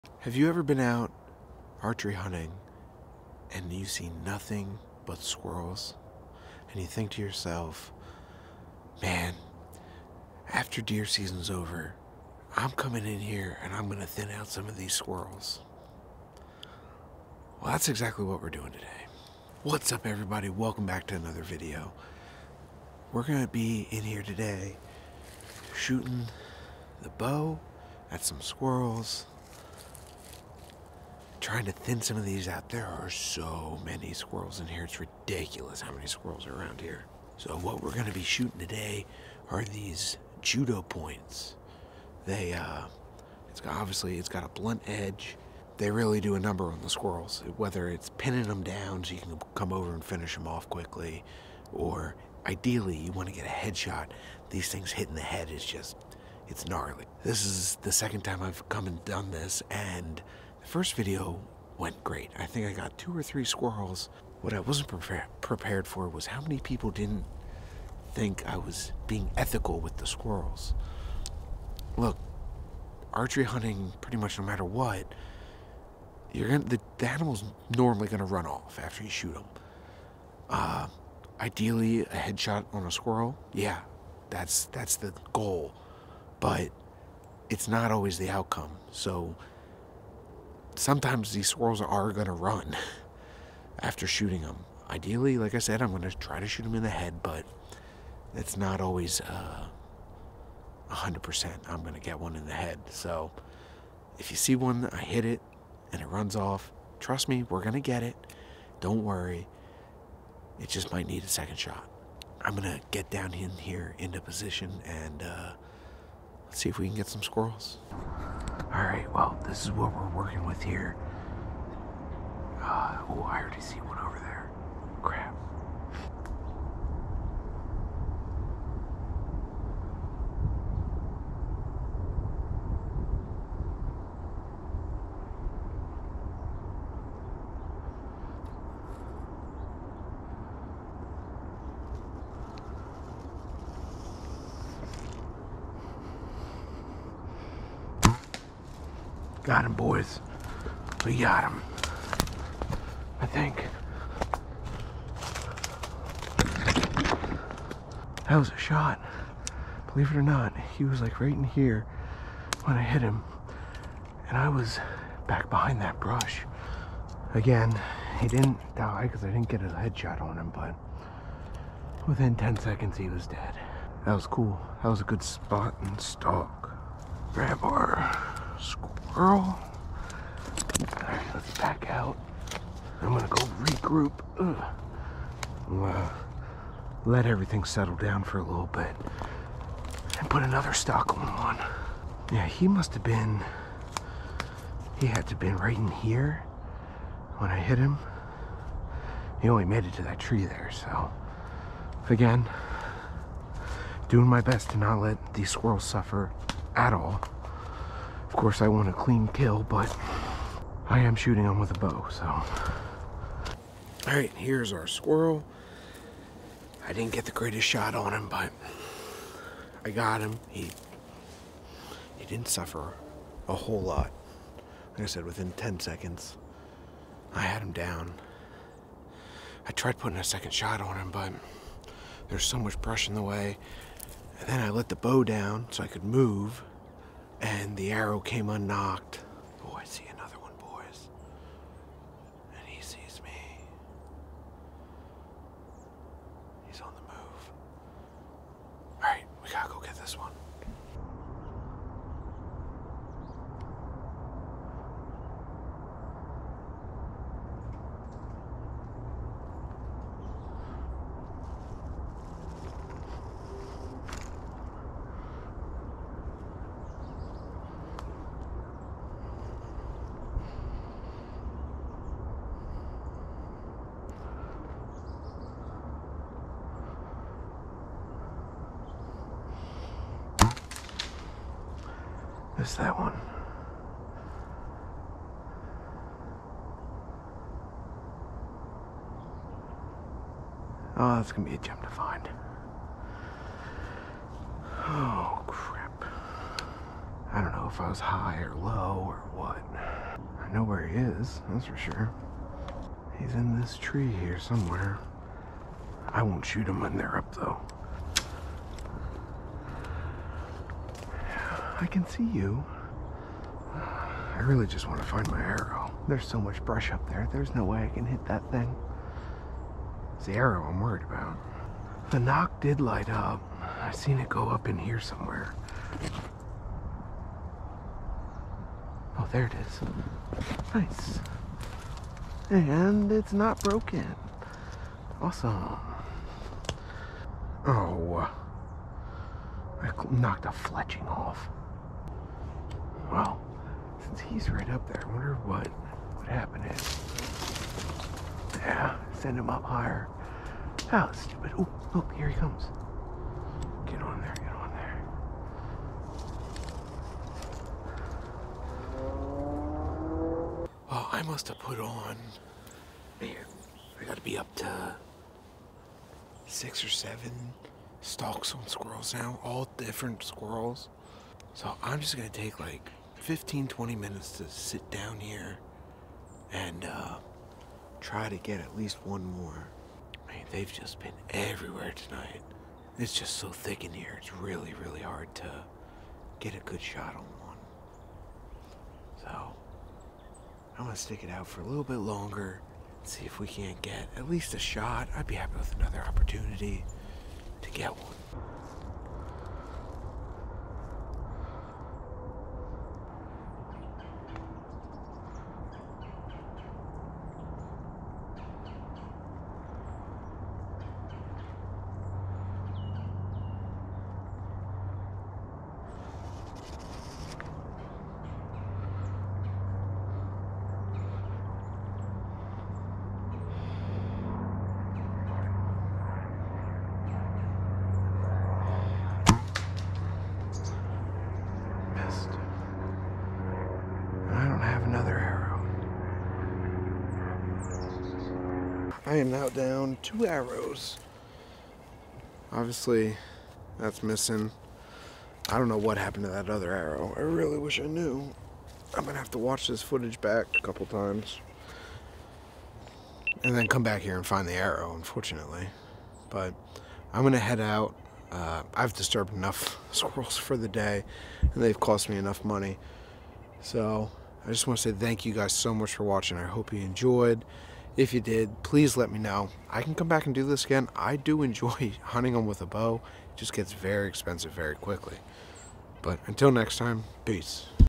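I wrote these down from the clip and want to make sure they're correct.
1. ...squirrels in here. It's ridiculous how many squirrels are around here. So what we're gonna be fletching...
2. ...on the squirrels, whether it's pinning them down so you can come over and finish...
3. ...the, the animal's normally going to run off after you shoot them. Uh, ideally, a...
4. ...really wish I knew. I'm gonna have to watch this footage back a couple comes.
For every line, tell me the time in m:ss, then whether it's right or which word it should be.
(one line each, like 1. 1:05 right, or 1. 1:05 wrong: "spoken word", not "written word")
1. 0:34 wrong: "shooting", not "fletching"
2. 0:46 right
3. 1:16 right
4. 7:27 wrong: "times", not "comes".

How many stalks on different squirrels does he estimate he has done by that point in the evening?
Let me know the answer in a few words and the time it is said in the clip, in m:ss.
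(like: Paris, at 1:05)
6 or 7, at 6:06.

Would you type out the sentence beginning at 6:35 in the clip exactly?
I'd be happy with another opportunity to get one.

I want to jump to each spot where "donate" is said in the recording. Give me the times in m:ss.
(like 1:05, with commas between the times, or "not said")
not said.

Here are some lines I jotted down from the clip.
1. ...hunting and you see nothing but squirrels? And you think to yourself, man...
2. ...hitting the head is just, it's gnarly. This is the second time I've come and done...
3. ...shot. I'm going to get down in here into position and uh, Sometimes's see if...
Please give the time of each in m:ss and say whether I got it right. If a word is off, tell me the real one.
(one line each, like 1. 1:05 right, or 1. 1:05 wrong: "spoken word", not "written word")
1. 0:02 right
2. 0:54 right
3. 1:51 wrong: "Let", not "Sometimes".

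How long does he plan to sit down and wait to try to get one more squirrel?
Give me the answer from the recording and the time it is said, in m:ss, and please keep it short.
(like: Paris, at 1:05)
15 to 20 minutes, at 6:13.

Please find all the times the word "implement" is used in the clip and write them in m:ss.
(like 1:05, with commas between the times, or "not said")
not said.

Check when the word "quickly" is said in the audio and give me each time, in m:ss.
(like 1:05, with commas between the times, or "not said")
0:50, 7:54.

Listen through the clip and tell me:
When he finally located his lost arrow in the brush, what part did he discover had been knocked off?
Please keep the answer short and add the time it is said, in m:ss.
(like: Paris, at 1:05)
a fletching, at 5:40.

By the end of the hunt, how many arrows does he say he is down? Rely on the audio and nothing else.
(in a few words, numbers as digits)
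2.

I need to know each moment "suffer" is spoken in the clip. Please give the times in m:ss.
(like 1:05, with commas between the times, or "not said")
3:25, 3:42.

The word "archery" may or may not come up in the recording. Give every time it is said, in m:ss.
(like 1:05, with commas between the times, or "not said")
0:01, 1:13.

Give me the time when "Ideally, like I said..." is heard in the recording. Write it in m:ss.
1:34.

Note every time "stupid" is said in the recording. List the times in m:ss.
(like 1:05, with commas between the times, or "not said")
5:51.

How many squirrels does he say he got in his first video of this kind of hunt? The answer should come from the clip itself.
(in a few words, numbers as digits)
2 or 3.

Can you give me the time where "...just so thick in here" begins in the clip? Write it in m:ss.
6:23.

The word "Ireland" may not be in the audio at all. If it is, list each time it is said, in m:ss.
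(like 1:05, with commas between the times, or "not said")
not said.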